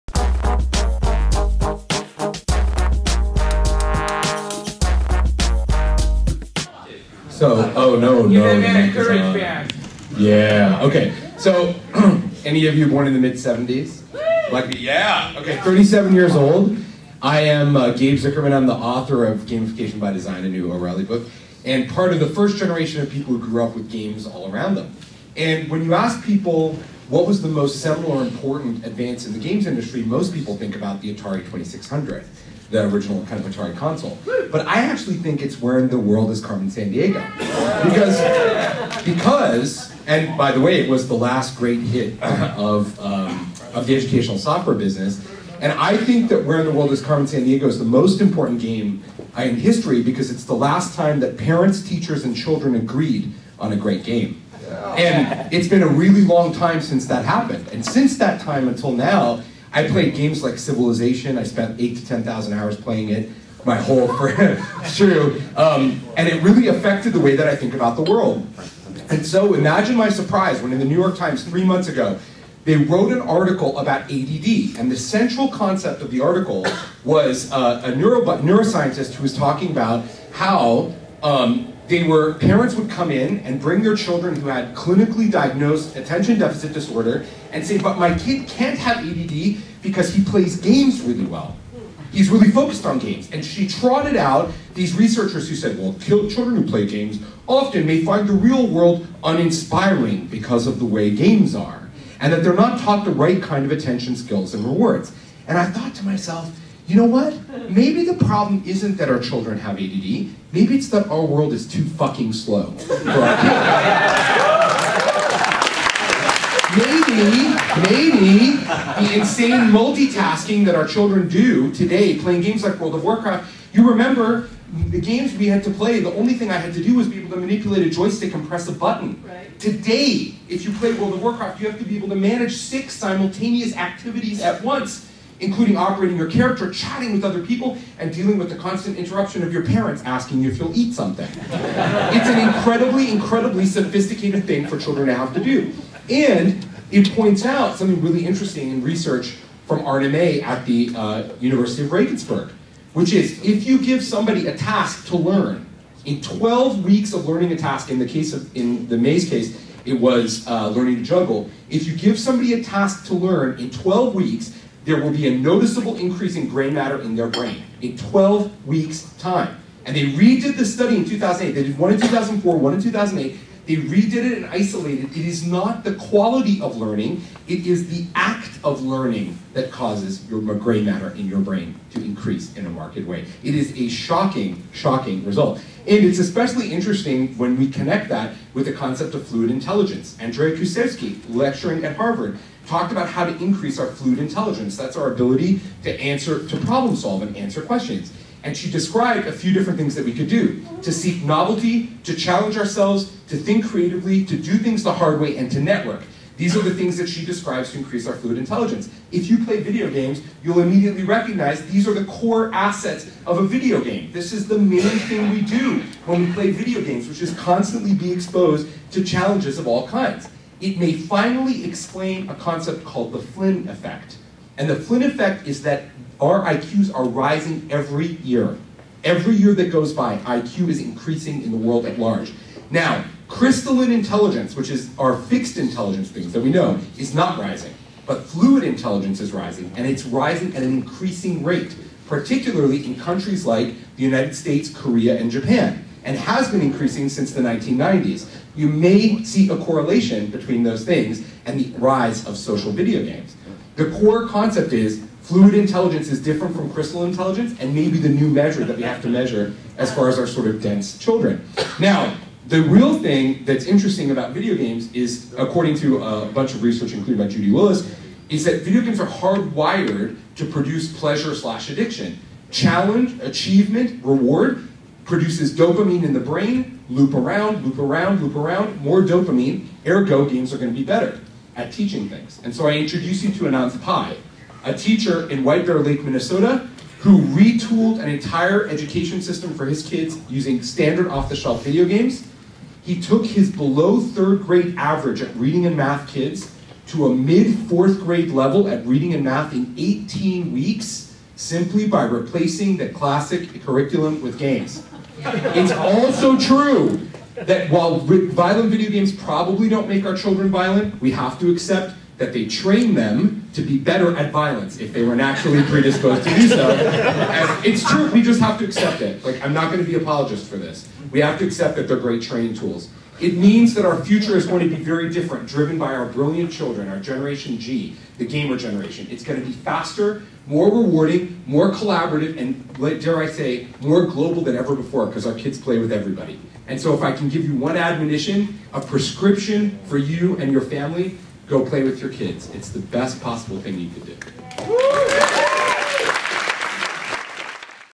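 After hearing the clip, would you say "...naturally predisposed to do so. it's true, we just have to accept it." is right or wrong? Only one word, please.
right.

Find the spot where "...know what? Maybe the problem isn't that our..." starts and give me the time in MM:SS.
01:46.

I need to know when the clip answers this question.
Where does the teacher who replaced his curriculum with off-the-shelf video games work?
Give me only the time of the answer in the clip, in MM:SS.
04:45.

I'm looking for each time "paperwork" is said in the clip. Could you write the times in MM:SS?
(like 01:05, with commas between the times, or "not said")
not said.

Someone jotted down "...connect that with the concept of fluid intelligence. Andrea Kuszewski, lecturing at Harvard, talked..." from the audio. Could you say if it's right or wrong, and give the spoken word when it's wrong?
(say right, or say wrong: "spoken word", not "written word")
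right.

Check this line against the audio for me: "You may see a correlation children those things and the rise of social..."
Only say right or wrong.
wrong.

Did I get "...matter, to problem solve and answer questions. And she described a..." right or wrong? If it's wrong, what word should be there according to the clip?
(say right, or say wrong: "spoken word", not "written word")
wrong: "answer", not "matter".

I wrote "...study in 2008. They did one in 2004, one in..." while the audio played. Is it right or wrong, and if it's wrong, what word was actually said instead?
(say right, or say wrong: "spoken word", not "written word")
right.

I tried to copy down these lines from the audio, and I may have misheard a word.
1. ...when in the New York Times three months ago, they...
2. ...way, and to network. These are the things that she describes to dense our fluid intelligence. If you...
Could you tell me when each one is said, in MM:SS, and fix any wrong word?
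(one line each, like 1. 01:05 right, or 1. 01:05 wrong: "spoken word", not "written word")
1. 01:10 right
2. 03:25 wrong: "increase", not "dense".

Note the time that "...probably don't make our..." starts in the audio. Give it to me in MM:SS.
05:09.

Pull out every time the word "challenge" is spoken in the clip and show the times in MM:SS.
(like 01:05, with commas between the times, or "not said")
03:22, 03:39, 04:32.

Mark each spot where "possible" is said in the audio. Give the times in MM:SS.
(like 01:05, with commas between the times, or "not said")
05:43.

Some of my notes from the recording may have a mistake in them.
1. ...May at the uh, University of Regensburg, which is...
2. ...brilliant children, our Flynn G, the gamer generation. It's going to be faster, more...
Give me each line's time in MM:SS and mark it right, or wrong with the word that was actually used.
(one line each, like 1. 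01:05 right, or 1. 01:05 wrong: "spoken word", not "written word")
1. 02:30 right
2. 05:26 wrong: "Generation", not "Flynn".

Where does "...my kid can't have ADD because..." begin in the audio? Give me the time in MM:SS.
01:27.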